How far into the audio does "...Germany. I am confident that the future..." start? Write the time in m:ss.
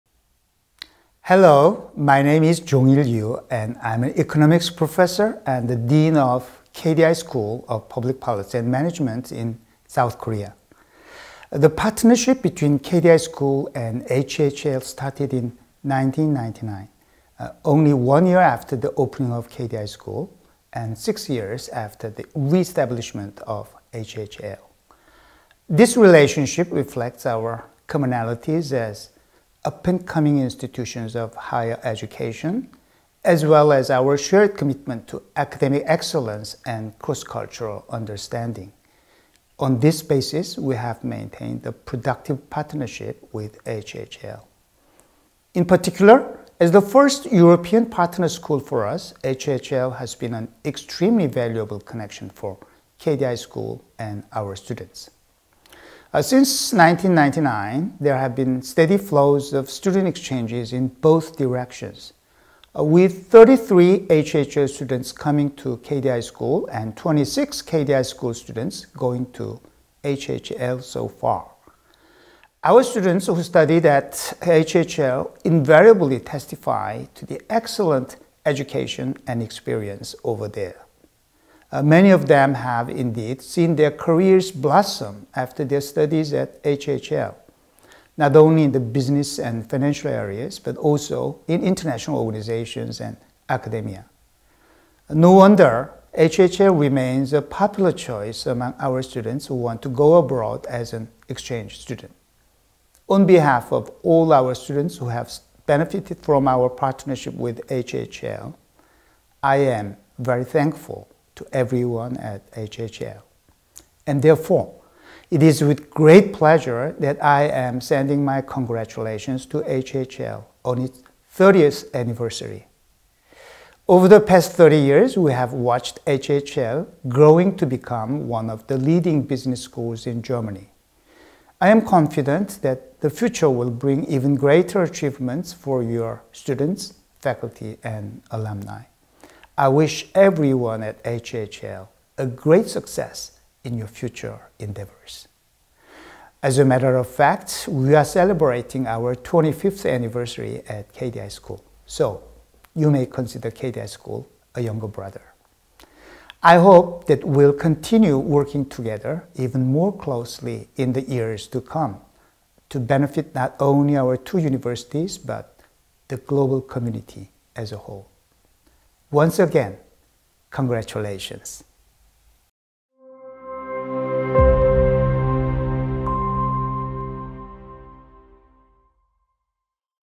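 2:10.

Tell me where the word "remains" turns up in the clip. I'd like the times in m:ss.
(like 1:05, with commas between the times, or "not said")
1:36.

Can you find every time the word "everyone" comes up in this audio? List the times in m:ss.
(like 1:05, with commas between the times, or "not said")
1:51, 2:20.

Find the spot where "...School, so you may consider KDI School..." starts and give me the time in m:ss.
2:31.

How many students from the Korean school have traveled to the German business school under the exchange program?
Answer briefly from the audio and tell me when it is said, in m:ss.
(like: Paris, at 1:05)
26, at 1:06.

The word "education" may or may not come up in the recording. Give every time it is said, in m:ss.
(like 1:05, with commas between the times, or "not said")
0:31, 1:18.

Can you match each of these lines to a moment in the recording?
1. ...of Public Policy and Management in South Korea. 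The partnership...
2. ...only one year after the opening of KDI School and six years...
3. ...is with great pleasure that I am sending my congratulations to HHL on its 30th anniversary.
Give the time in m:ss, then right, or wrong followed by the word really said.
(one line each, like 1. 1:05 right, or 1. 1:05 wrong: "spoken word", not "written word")
1. 0:07 right
2. 0:17 right
3. 1:55 right.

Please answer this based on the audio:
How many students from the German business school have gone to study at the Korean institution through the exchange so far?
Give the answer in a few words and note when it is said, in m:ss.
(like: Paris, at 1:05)
33, at 1:03.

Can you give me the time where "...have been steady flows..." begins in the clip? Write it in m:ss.
0:58.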